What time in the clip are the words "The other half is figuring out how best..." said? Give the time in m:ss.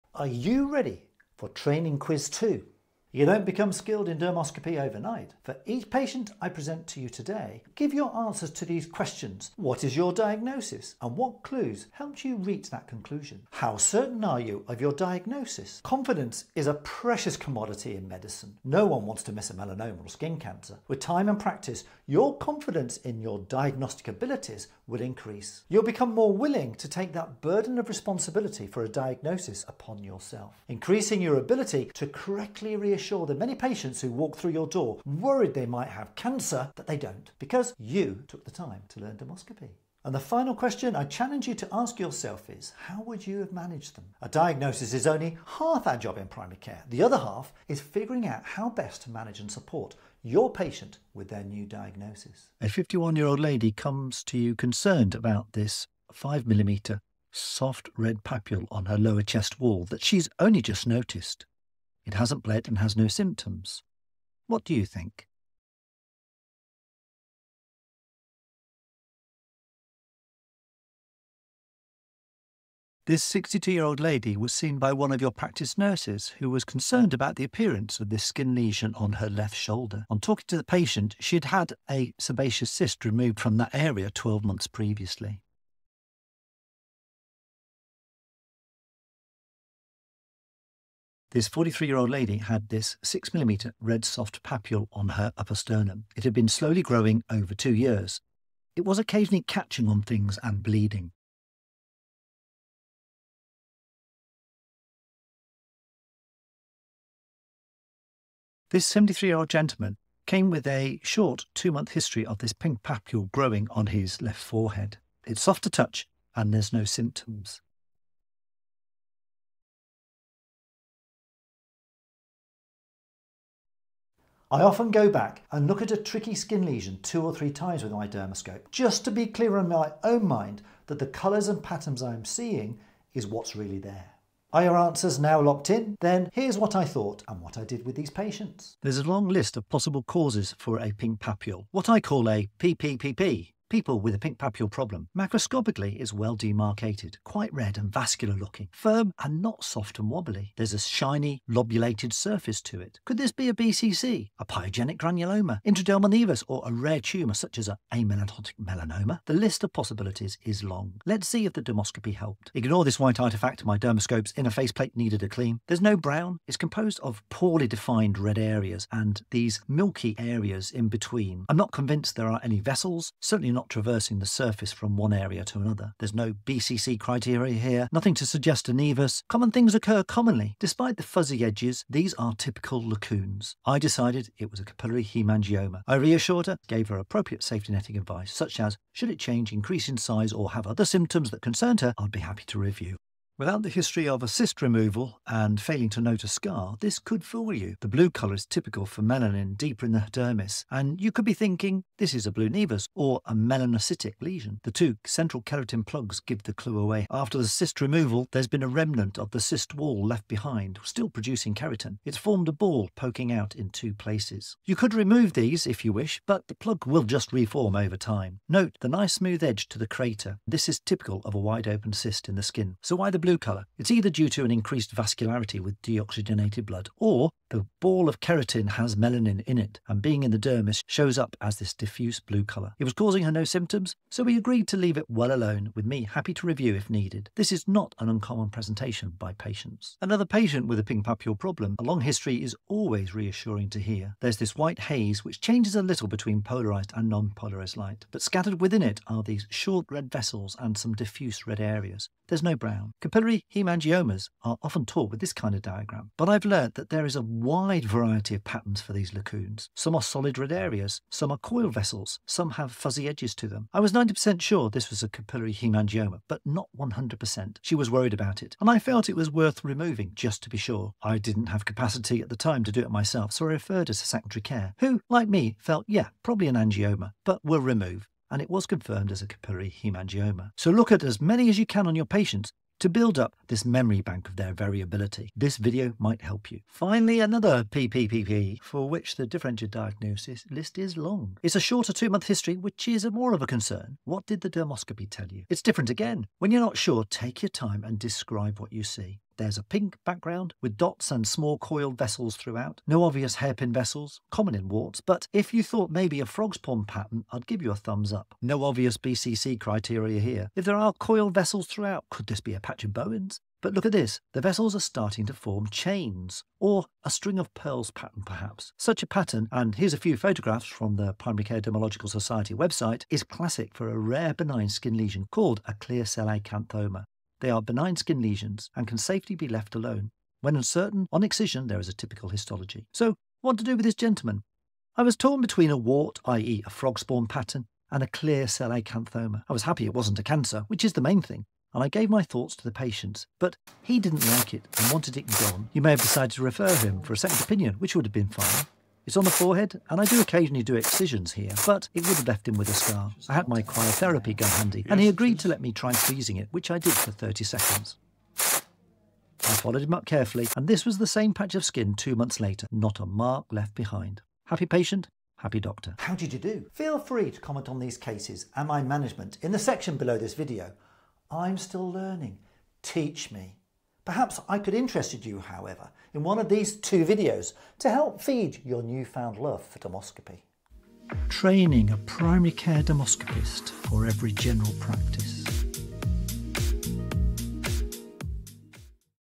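0:46.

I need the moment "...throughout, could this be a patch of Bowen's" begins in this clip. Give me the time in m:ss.
5:11.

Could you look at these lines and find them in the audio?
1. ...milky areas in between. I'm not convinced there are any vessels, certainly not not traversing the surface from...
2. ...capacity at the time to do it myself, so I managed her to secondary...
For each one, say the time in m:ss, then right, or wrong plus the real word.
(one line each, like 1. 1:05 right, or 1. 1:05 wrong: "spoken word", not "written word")
1. 2:49 right
2. 4:31 wrong: "referred", not "managed".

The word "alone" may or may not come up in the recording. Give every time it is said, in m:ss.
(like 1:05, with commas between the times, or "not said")
3:55, 5:29.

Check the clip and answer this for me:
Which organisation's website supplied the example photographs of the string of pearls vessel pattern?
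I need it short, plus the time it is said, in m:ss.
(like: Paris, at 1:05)
Primary Care Dermatological Society, at 5:21.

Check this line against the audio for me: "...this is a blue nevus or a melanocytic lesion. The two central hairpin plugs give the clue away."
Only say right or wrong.
wrong.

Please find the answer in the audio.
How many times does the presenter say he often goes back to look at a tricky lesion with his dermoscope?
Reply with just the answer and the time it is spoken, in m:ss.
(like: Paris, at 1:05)
two or three, at 2:07.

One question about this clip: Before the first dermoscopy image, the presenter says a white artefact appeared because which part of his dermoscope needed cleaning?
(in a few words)
inner faceplate.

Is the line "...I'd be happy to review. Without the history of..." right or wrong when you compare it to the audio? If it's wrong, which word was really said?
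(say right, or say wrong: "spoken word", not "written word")
right.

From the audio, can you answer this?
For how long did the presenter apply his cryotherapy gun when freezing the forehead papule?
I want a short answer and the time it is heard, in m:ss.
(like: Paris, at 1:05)
30 seconds, at 5:57.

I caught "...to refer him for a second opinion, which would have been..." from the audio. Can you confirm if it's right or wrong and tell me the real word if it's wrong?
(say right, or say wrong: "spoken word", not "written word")
right.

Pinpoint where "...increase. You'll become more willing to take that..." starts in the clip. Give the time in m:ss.
0:25.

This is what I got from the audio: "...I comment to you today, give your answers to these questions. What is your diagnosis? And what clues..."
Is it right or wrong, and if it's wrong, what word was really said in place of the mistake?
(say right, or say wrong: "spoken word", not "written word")
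wrong: "present", not "comment".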